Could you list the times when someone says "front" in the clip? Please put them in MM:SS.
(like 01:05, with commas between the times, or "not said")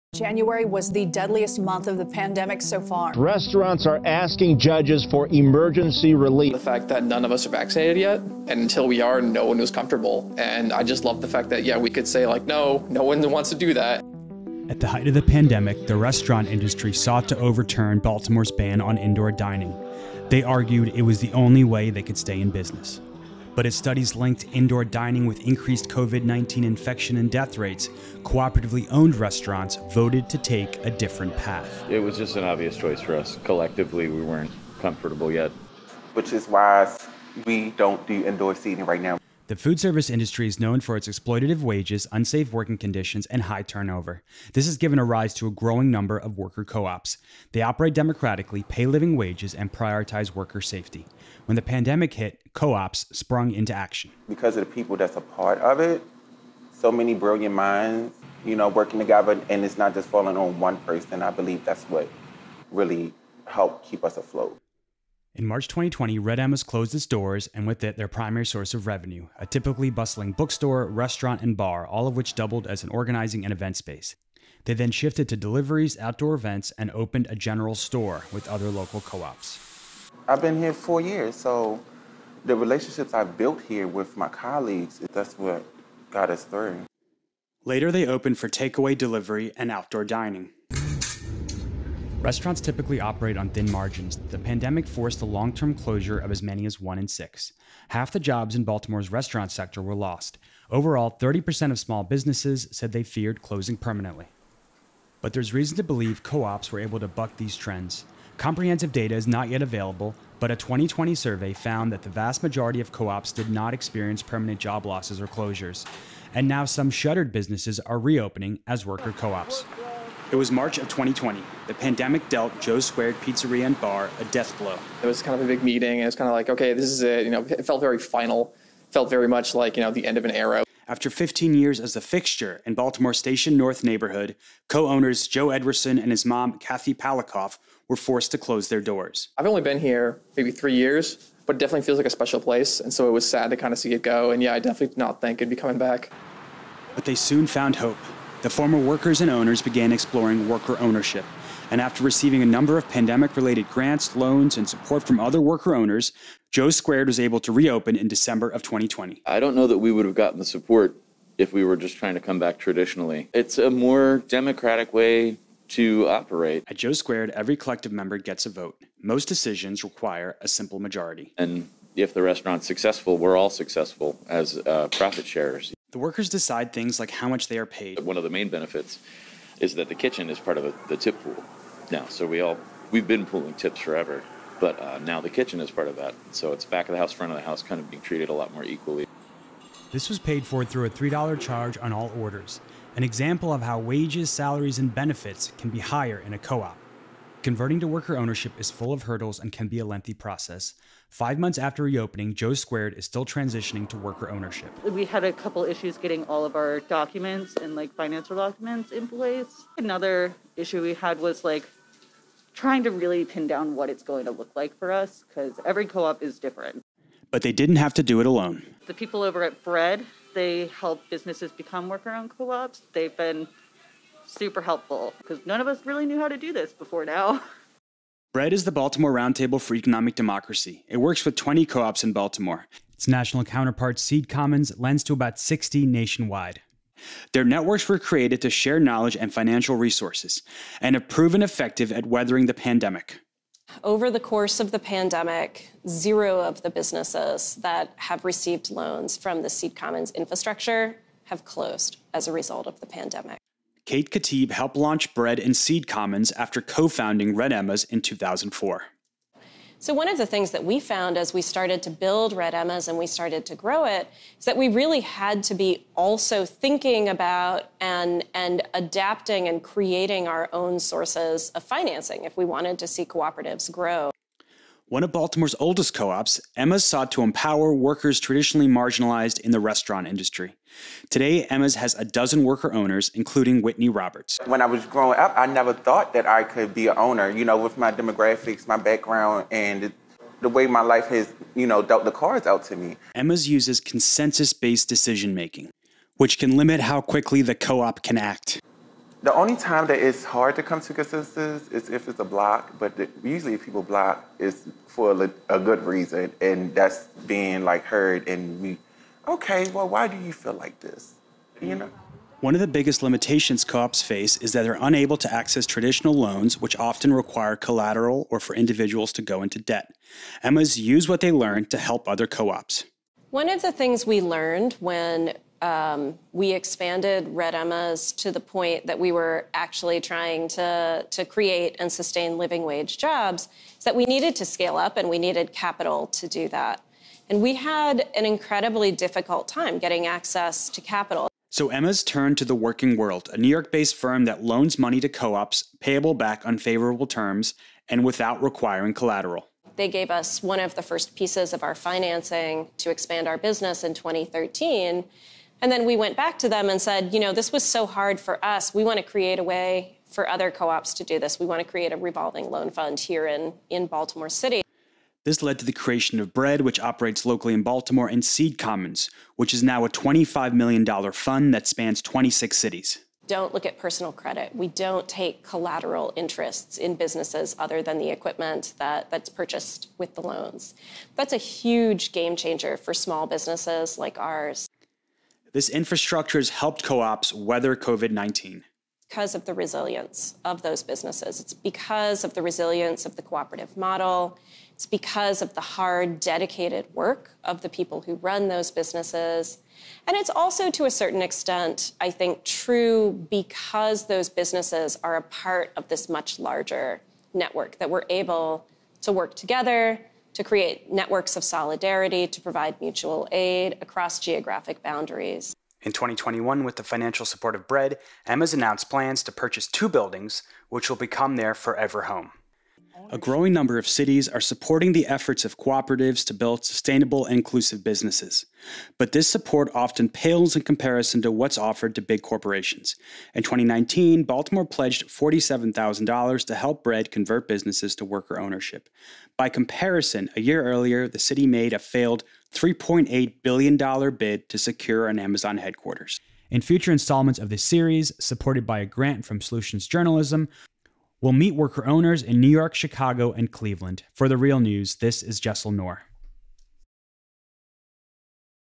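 03:07.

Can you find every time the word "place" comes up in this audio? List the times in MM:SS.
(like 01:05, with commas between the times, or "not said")
02:22, 03:29.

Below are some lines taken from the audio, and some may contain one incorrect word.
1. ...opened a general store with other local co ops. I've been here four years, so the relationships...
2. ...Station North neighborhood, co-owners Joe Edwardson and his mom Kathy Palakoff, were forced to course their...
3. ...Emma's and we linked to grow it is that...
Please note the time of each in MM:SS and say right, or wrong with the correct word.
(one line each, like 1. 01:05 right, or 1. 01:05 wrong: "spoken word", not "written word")
1. 01:16 right
2. 02:13 wrong: "close", not "course"
3. 04:22 wrong: "started", not "linked".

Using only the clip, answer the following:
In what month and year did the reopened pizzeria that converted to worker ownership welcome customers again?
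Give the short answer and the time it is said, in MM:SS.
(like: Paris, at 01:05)
December 2020, at 02:38.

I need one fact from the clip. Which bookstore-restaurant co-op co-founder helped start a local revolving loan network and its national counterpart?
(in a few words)
Kate Khatib.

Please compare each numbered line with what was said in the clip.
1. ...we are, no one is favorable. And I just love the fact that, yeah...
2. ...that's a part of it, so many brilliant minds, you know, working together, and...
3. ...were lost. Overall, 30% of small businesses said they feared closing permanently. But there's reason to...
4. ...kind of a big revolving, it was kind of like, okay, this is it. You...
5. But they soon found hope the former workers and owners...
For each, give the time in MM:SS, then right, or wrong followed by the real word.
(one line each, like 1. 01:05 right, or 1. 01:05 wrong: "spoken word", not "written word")
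1. 00:08 wrong: "comfortable", not "favorable"
2. 00:54 right
3. 01:39 right
4. 02:05 wrong: "meeting", not "revolving"
5. 02:26 right.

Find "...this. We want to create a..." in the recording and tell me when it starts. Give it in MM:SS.
06:01.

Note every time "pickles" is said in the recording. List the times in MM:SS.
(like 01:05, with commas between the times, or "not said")
not said.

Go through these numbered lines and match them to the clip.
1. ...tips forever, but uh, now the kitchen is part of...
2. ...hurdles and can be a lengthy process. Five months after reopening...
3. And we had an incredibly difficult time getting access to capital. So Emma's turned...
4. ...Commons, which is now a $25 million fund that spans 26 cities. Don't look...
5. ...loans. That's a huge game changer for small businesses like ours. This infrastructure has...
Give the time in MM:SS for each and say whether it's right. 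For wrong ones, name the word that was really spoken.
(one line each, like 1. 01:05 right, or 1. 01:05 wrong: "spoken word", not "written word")
1. 03:03 right
2. 03:19 right
3. 05:37 right
4. 06:08 right
5. 06:20 right.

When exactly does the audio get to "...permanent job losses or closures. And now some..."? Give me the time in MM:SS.
01:54.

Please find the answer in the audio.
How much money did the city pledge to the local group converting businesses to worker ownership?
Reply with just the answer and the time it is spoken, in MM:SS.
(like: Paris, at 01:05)
$47,000, at 07:15.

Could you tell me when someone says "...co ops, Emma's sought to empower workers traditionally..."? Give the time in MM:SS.
04:35.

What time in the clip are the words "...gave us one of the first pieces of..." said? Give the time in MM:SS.
05:49.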